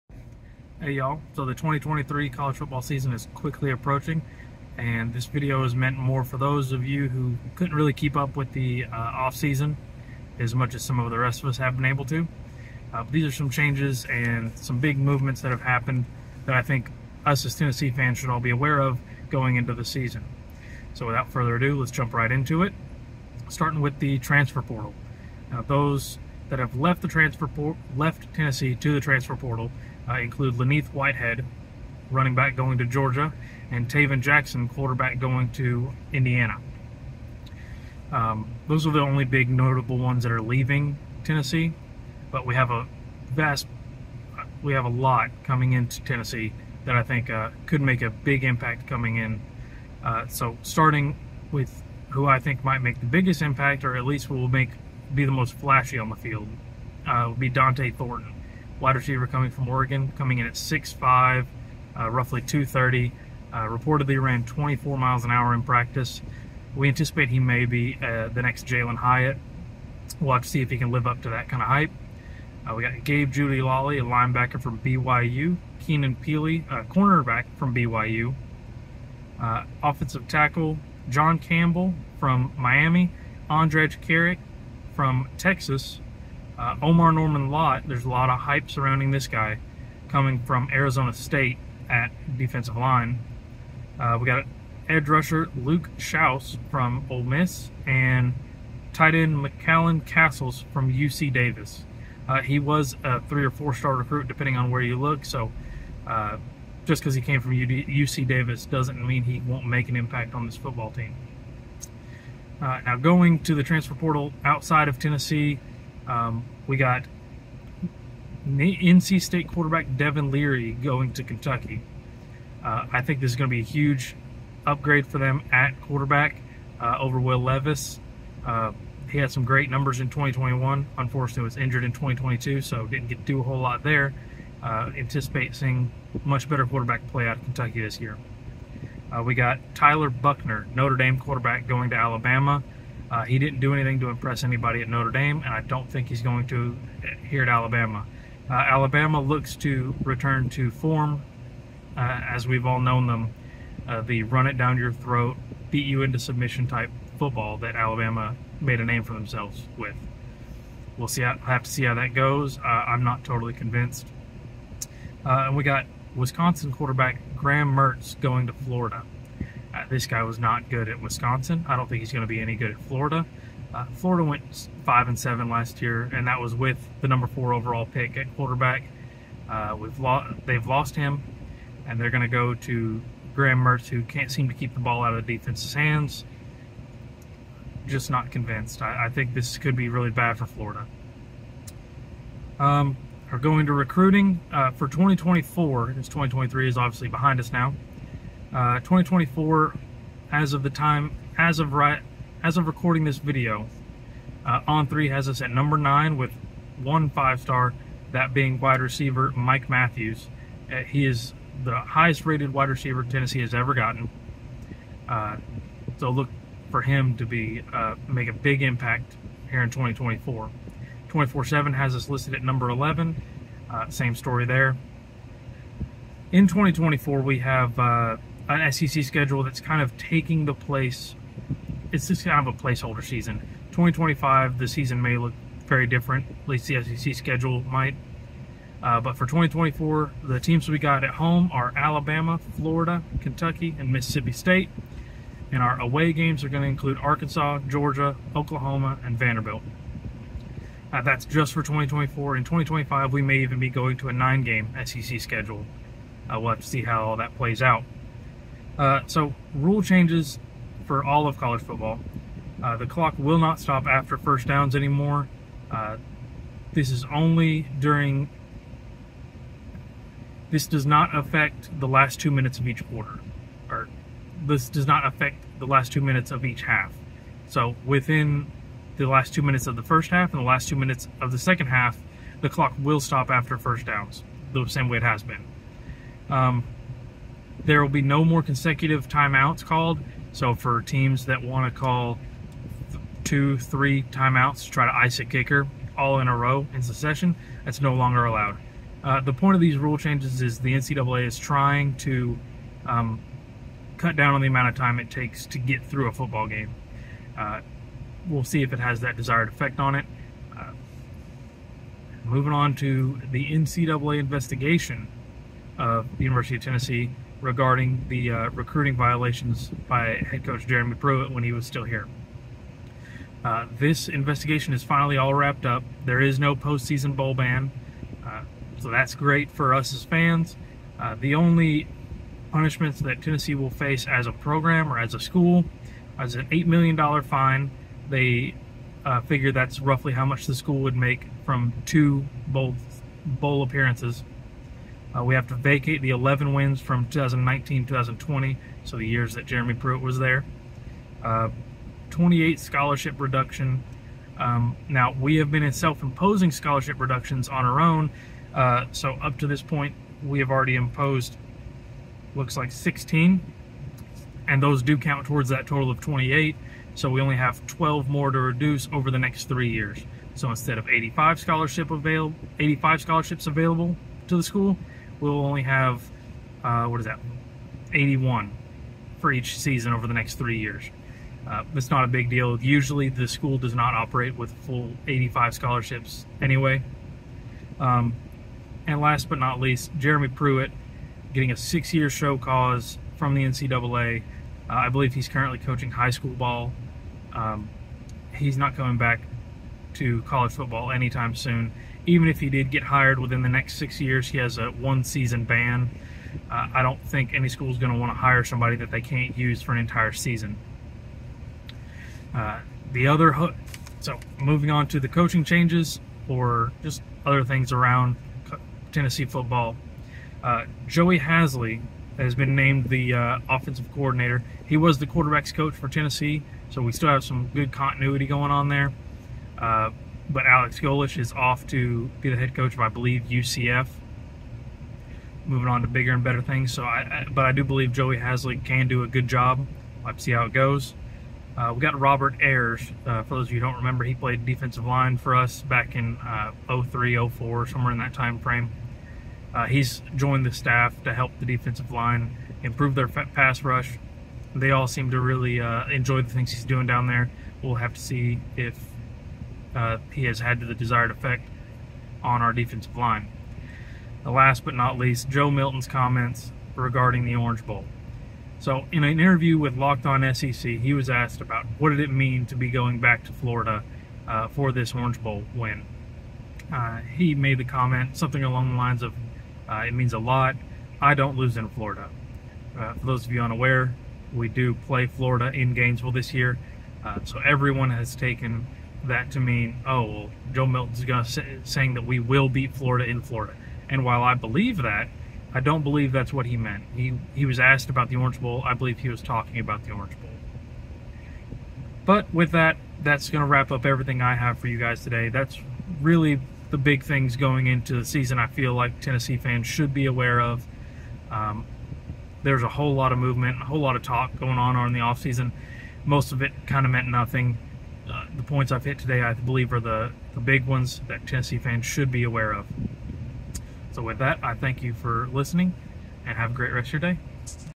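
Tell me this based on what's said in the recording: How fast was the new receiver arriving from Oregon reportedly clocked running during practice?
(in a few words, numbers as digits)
24 miles an hour.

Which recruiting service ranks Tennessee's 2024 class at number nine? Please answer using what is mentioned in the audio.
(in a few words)
On3.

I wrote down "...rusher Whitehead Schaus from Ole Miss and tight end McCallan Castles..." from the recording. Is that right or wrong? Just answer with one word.
wrong.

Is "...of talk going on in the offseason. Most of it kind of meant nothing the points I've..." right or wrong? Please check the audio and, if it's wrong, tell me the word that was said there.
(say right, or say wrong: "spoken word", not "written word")
right.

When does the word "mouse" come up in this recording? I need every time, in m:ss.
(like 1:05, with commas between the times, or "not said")
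not said.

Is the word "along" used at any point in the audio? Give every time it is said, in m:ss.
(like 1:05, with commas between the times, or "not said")
7:58.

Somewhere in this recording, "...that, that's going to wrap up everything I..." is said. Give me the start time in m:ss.
8:22.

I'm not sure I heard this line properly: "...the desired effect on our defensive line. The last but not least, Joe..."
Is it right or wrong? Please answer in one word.
right.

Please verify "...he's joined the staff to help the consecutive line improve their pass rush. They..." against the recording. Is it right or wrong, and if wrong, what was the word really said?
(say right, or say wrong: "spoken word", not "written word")
wrong: "defensive", not "consecutive".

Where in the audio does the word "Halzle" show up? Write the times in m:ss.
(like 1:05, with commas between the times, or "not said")
7:01, 7:18.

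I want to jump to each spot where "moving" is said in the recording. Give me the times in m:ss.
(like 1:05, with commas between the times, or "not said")
5:12, 6:54, 7:15.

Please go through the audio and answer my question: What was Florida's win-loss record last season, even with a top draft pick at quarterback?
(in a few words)
5-7.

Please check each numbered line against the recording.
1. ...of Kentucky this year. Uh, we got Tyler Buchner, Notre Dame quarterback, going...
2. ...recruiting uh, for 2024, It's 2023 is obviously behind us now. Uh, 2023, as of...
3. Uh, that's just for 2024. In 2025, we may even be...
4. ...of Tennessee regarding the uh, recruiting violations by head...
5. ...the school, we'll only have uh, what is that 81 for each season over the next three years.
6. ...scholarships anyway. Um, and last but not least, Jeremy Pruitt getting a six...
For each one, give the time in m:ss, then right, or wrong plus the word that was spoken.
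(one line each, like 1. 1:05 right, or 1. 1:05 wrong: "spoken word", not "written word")
1. 2:17 right
2. 3:13 wrong: "2024", not "2023"
3. 4:10 right
4. 5:16 right
5. 6:14 right
6. 6:25 right.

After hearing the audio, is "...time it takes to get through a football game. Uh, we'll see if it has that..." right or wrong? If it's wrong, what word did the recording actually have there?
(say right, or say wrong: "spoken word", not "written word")
right.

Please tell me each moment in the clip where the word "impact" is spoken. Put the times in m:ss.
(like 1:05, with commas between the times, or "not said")
0:48, 0:53, 1:49, 3:38.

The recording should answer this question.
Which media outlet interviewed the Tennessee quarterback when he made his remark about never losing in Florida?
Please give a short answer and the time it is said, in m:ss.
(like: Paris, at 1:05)
Locked On SEC, at 7:49.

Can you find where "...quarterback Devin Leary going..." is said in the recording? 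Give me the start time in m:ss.
1:59.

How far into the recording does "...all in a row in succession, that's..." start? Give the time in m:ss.
4:55.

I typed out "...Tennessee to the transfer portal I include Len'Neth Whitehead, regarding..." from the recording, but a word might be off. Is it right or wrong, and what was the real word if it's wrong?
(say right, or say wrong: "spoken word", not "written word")
wrong: "running", not "regarding".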